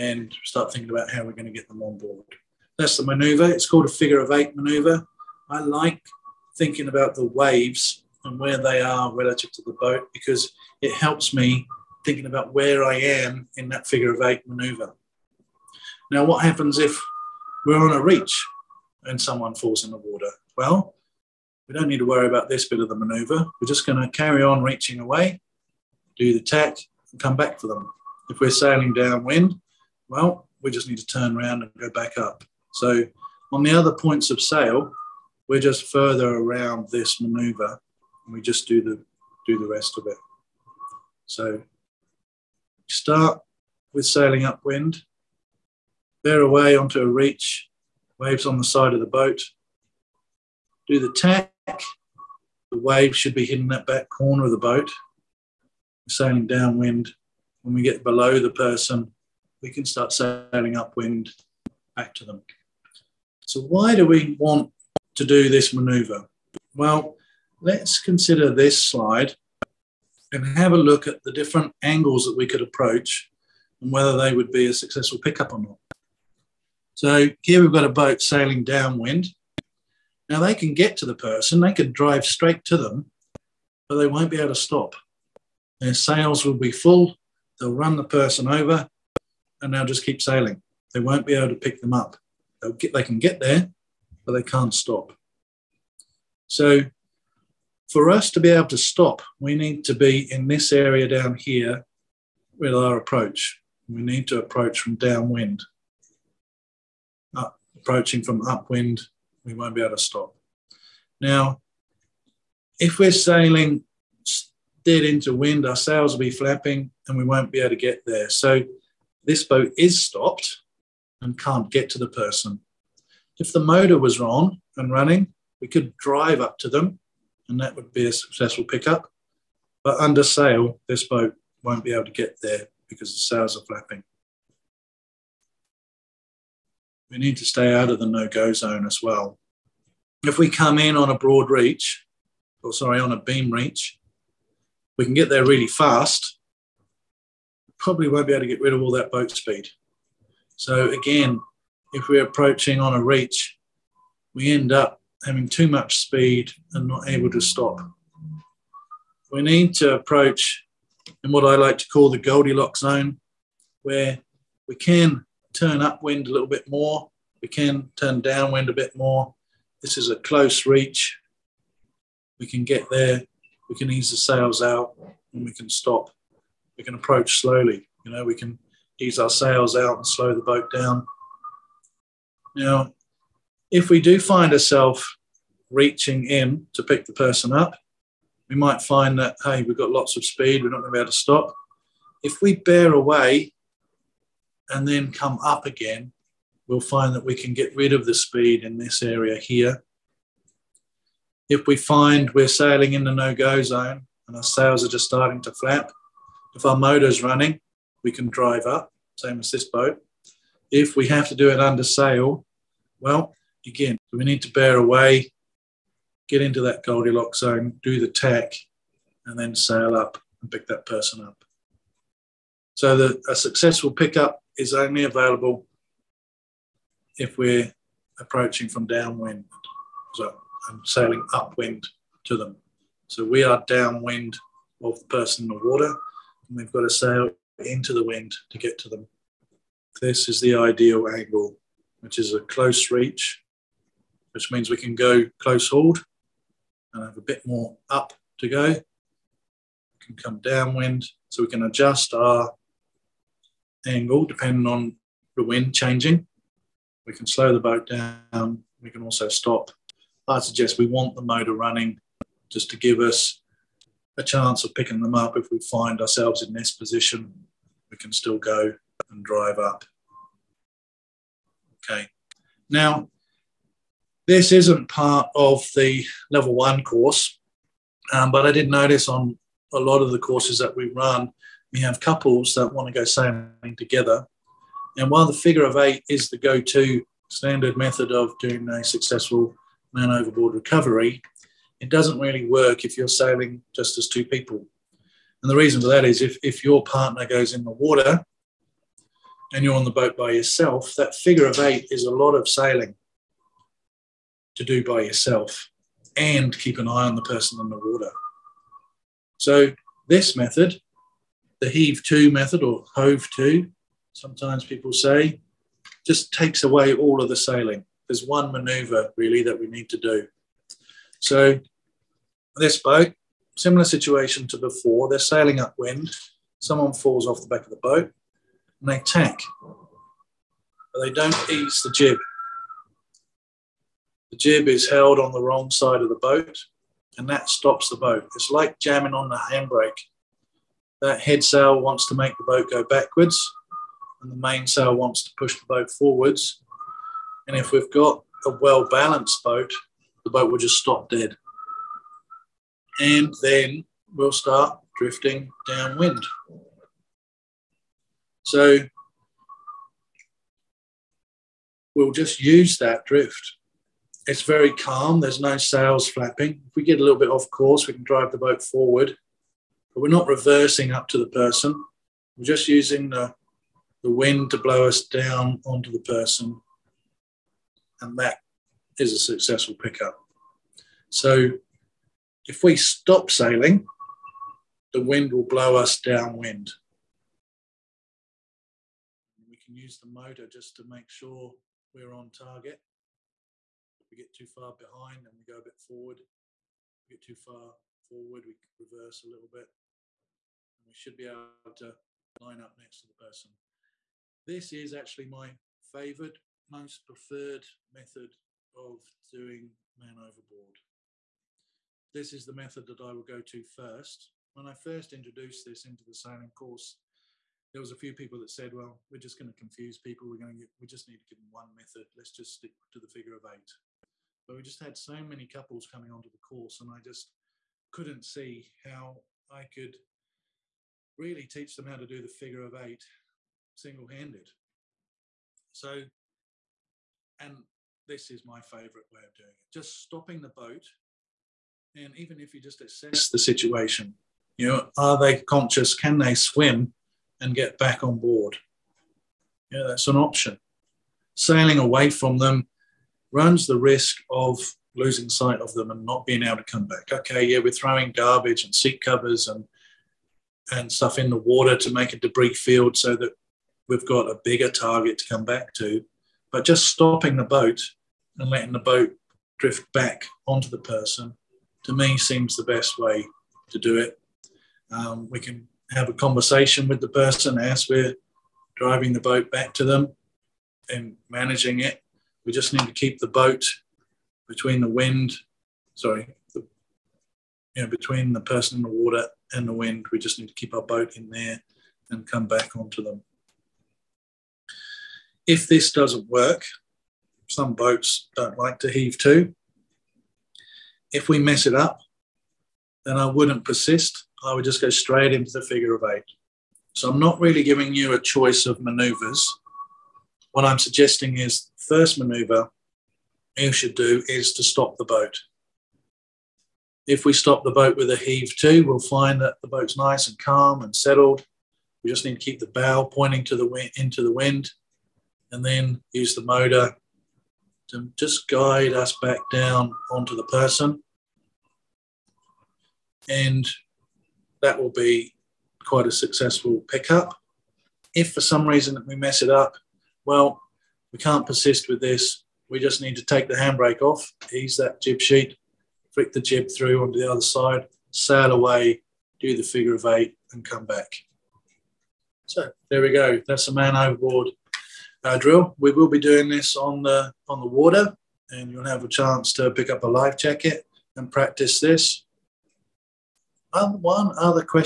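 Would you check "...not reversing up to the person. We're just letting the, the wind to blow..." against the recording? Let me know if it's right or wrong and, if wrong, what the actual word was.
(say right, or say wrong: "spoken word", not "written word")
wrong: "using", not "letting".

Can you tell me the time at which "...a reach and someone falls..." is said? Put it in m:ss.
0:17.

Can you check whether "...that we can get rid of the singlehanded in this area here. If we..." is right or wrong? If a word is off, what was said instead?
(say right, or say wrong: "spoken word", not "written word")
wrong: "speed", not "singlehanded".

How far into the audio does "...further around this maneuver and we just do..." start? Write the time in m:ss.
0:35.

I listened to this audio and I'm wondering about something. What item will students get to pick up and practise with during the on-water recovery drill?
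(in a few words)
A life jacket.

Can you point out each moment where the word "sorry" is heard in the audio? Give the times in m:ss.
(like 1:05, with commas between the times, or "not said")
2:22, 8:05.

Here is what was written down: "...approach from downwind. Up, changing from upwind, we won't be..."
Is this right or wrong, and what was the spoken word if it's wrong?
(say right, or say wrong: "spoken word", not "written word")
wrong: "approaching", not "changing".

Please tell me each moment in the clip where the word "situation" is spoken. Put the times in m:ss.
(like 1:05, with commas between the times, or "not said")
5:23, 7:23.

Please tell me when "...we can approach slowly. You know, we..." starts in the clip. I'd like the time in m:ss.
2:56.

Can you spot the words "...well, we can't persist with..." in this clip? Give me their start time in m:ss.
9:00.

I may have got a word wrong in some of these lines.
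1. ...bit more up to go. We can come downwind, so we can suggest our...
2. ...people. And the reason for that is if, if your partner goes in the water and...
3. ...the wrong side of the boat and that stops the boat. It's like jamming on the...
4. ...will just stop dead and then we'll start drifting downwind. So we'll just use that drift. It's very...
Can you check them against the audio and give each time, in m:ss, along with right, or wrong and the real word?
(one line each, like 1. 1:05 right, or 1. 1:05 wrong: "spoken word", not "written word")
1. 4:07 wrong: "adjust", not "suggest"
2. 4:54 right
3. 5:35 right
4. 5:50 right.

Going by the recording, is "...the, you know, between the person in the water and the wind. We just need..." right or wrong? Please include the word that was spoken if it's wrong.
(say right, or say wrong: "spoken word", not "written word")
right.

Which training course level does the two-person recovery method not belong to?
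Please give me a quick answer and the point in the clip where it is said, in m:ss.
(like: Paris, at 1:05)
Level one, at 4:36.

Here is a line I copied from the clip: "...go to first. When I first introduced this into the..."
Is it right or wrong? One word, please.
right.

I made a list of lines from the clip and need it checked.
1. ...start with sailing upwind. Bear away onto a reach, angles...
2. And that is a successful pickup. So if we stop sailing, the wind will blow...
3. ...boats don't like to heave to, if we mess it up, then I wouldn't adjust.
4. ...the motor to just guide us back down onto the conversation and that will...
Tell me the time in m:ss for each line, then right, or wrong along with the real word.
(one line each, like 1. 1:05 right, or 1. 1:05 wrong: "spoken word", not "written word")
1. 0:42 wrong: "waves", not "angles"
2. 6:17 right
3. 8:17 wrong: "persist", not "adjust"
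4. 8:46 wrong: "person", not "conversation".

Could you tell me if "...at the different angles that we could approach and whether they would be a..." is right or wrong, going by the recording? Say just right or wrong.
right.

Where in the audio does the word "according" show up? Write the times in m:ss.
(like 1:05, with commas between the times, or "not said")
not said.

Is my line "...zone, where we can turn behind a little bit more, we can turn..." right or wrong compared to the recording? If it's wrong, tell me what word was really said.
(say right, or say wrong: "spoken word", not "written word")
wrong: "upwind", not "behind".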